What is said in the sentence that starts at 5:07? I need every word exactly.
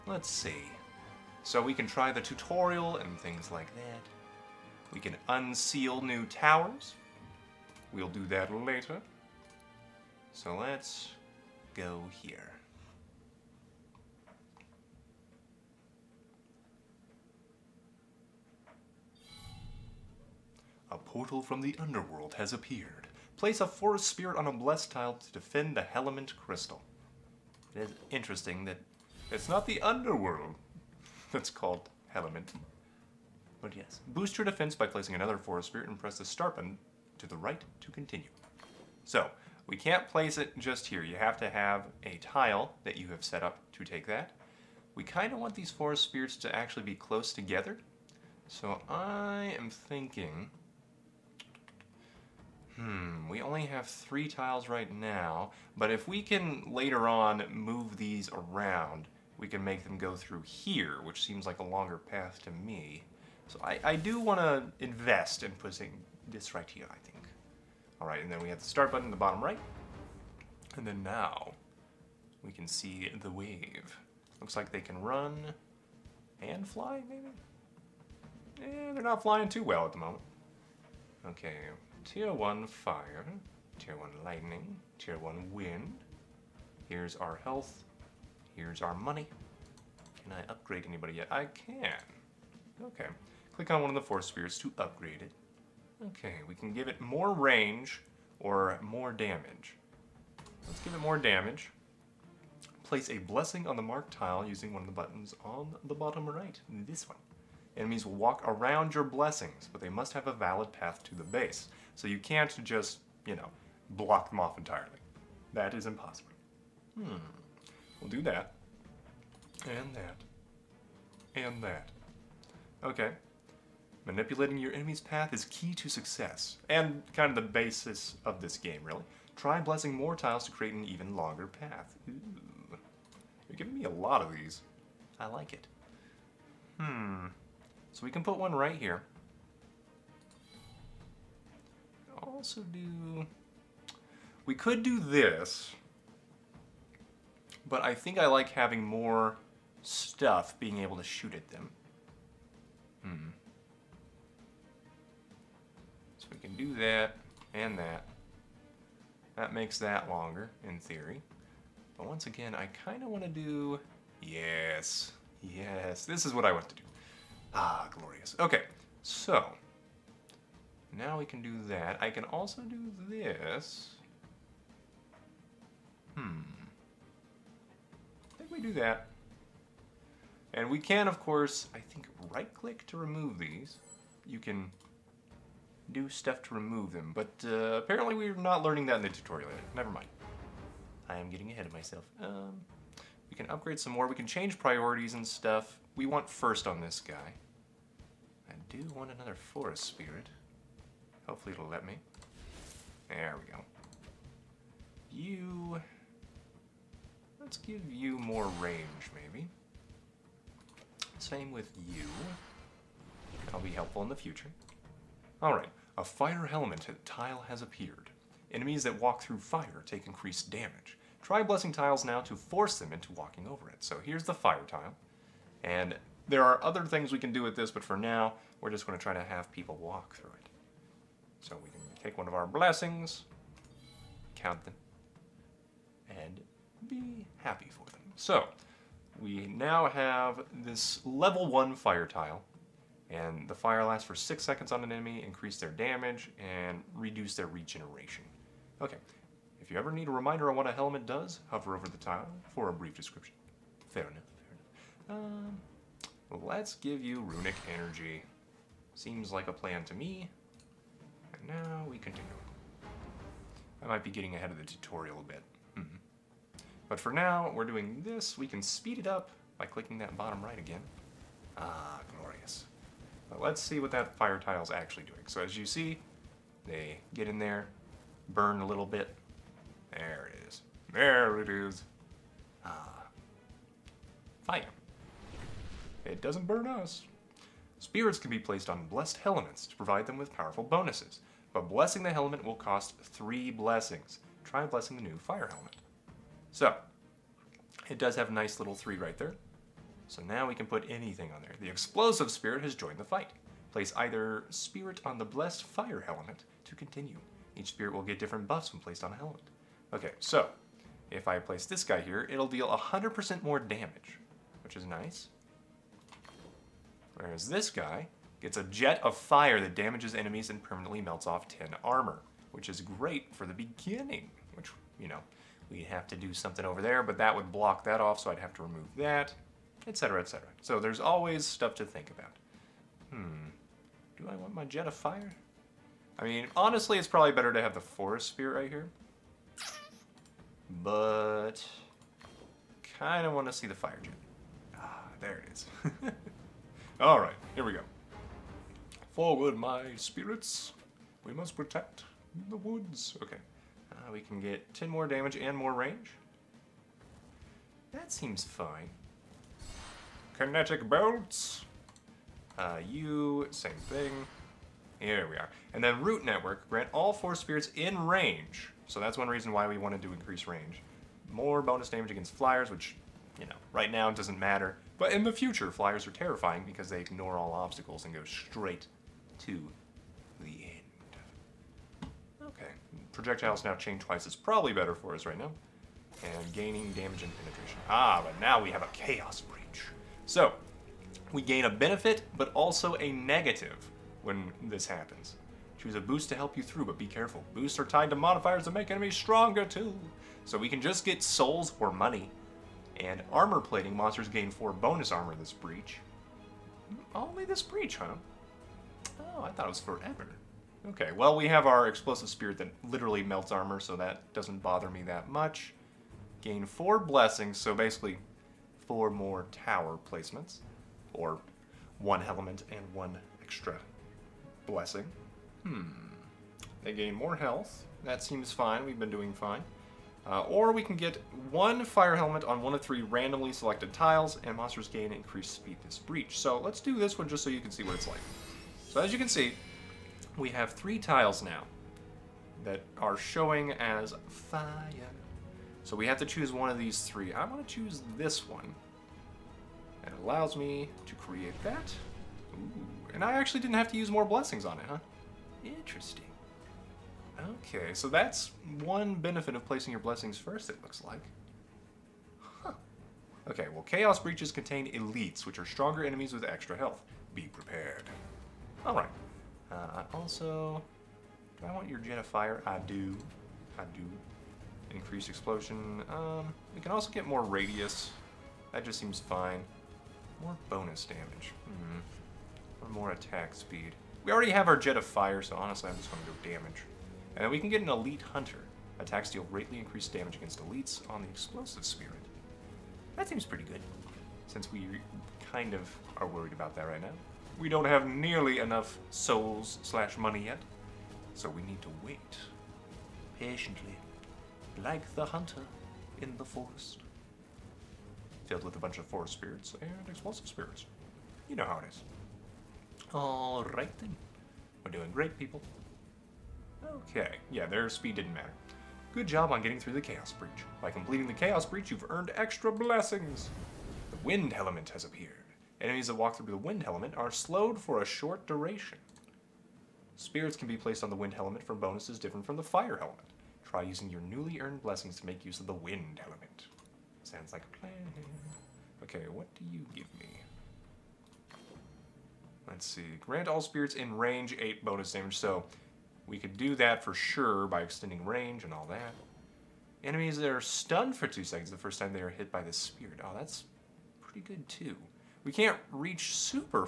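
Each spirit will get different buffs when placed on a Hellement.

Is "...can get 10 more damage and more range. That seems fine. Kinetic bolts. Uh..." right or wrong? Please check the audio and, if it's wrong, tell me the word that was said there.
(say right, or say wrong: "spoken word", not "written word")
right.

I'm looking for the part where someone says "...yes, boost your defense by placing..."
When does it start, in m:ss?
0:33.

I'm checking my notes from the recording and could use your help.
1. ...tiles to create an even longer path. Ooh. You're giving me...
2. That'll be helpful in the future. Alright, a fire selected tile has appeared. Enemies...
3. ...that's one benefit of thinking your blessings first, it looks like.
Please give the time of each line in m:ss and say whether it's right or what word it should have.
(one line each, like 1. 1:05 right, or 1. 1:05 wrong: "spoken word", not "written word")
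1. 2:10 right
2. 3:33 wrong: "helmeted", not "selected"
3. 7:38 wrong: "placing", not "thinking".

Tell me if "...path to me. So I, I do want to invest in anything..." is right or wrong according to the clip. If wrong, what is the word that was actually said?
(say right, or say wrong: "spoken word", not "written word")
wrong: "putting", not "anything".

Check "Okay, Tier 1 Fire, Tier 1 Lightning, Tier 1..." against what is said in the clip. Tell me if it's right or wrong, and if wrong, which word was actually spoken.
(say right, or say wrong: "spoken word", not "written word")
right.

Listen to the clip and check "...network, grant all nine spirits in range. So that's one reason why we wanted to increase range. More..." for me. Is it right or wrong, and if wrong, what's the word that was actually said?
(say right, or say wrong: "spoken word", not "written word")
wrong: "four", not "nine".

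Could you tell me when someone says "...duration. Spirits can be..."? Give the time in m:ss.
8:48.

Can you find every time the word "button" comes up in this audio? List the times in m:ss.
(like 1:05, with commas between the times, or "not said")
0:36, 1:08, 1:44.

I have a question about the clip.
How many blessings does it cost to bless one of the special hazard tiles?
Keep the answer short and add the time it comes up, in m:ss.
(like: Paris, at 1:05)
3, at 4:52.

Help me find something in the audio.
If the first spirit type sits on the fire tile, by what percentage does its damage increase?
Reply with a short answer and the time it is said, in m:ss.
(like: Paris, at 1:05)
100%, at 5:12.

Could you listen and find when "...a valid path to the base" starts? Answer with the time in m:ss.
1:50.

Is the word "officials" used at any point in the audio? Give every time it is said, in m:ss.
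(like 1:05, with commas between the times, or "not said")
not said.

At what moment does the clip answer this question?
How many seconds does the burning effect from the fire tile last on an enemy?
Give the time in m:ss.
4:04.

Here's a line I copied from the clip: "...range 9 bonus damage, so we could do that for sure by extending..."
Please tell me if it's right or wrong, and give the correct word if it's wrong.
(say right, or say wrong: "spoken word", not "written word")
wrong: "8", not "9".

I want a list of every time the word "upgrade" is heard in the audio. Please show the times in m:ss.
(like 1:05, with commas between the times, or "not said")
1:30, 1:34, 3:13.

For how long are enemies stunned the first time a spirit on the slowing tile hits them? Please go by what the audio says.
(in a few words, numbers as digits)
2 seconds.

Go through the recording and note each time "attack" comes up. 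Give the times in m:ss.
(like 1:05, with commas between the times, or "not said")
8:03, 8:08.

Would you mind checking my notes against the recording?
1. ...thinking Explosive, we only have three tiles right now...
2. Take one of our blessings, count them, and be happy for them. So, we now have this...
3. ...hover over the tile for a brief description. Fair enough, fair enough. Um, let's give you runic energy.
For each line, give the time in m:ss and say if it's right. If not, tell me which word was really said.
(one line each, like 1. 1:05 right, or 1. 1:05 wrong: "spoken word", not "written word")
1. 0:49 wrong: "Hmm", not "Explosive"
2. 3:52 right
3. 4:11 right.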